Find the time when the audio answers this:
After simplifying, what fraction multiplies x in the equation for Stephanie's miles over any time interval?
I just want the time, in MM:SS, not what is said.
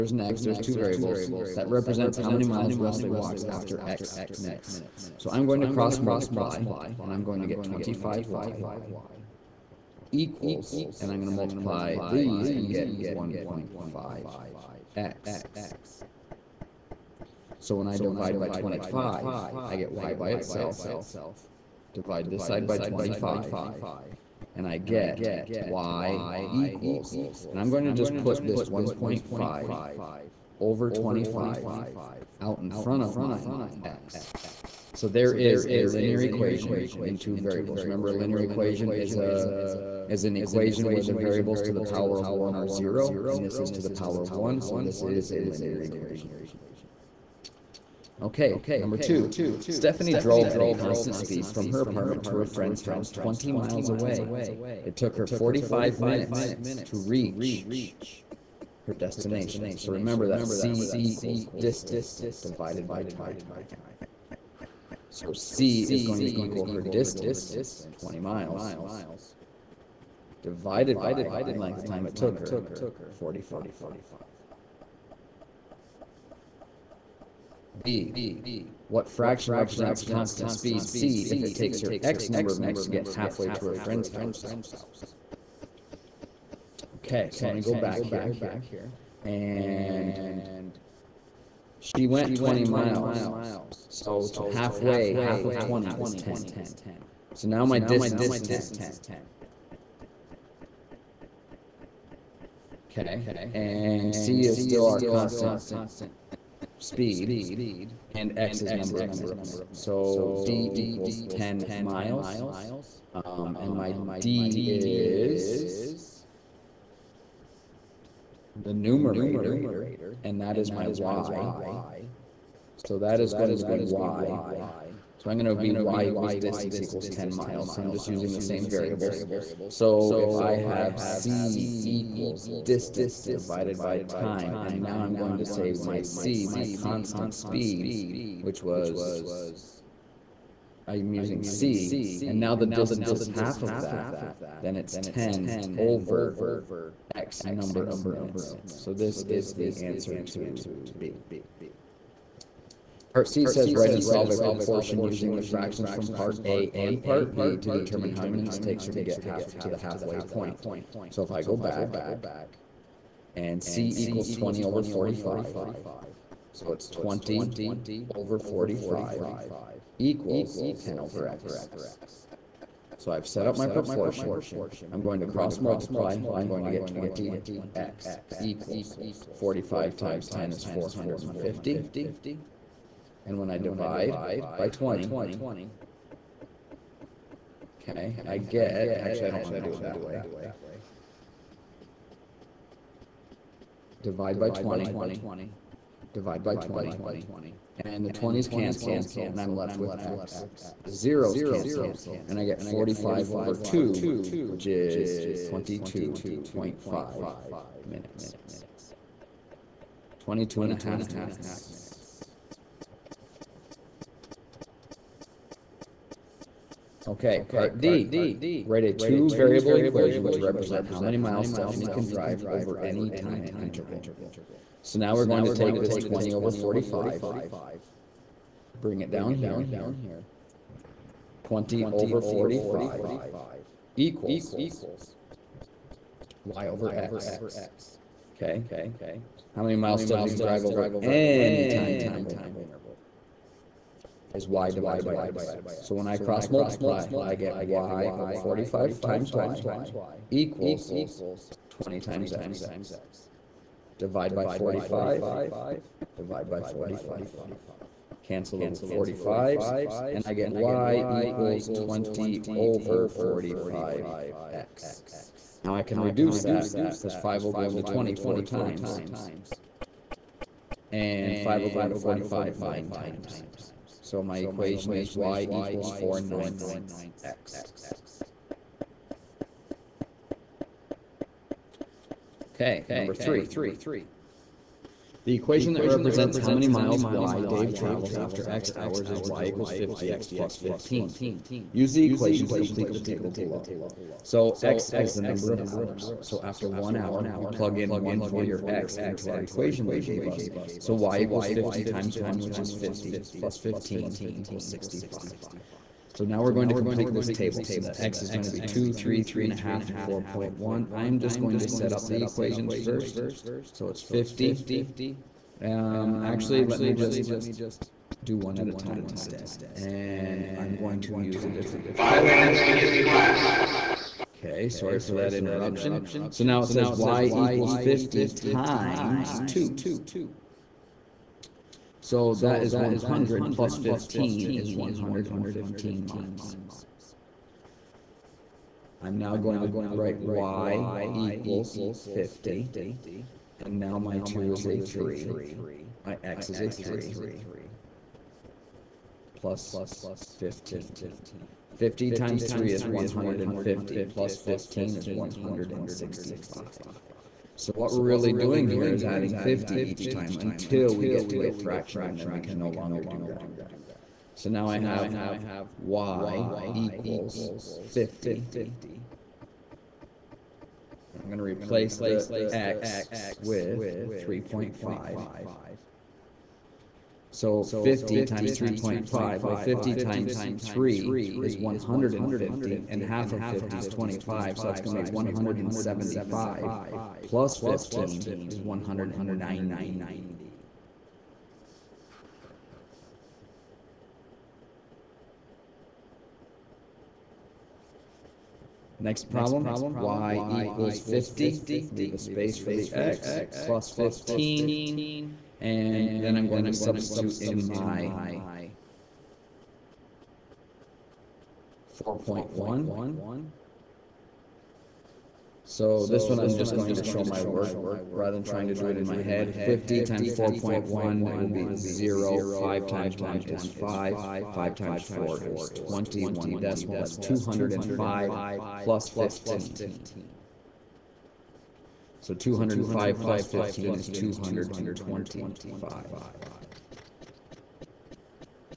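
04:35.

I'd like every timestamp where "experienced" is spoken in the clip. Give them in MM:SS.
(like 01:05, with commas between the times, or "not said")
not said.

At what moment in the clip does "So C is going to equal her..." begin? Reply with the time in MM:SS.
01:05.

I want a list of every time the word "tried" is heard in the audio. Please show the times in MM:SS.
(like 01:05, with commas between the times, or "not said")
not said.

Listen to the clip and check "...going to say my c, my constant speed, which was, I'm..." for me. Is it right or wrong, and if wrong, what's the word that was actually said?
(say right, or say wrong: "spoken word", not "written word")
right.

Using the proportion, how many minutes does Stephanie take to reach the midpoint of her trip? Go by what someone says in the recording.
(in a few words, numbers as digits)
22.5 minutes.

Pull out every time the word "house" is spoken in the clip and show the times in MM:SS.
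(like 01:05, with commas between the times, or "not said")
00:52, 01:24.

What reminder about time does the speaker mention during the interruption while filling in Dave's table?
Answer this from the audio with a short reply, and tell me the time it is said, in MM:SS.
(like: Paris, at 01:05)
5 minutes, at 05:21.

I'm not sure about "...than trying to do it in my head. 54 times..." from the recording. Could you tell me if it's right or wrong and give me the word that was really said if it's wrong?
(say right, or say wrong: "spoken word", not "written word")
wrong: "50", not "54".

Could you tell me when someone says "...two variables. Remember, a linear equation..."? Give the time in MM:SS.
00:37.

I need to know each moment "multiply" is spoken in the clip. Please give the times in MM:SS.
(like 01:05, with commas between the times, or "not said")
00:05, 00:11, 02:55, 04:06.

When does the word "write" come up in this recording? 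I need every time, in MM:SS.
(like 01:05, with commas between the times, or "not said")
02:33, 03:38, 05:39.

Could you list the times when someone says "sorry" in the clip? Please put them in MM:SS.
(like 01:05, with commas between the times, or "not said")
05:24.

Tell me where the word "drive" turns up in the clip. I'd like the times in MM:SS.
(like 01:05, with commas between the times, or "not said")
03:42, 04:00.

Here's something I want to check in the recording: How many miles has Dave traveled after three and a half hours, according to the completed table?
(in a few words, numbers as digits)
190.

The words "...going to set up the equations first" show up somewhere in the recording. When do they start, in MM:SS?
05:11.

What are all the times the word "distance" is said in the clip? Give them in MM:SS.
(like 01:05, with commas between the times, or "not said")
01:01, 01:06, 01:37, 02:06, 02:12, 02:22.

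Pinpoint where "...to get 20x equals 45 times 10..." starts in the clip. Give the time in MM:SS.
02:56.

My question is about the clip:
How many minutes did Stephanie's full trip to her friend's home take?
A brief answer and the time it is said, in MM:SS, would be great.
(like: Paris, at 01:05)
45 minutes, at 00:55.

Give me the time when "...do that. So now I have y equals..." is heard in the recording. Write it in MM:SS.
06:03.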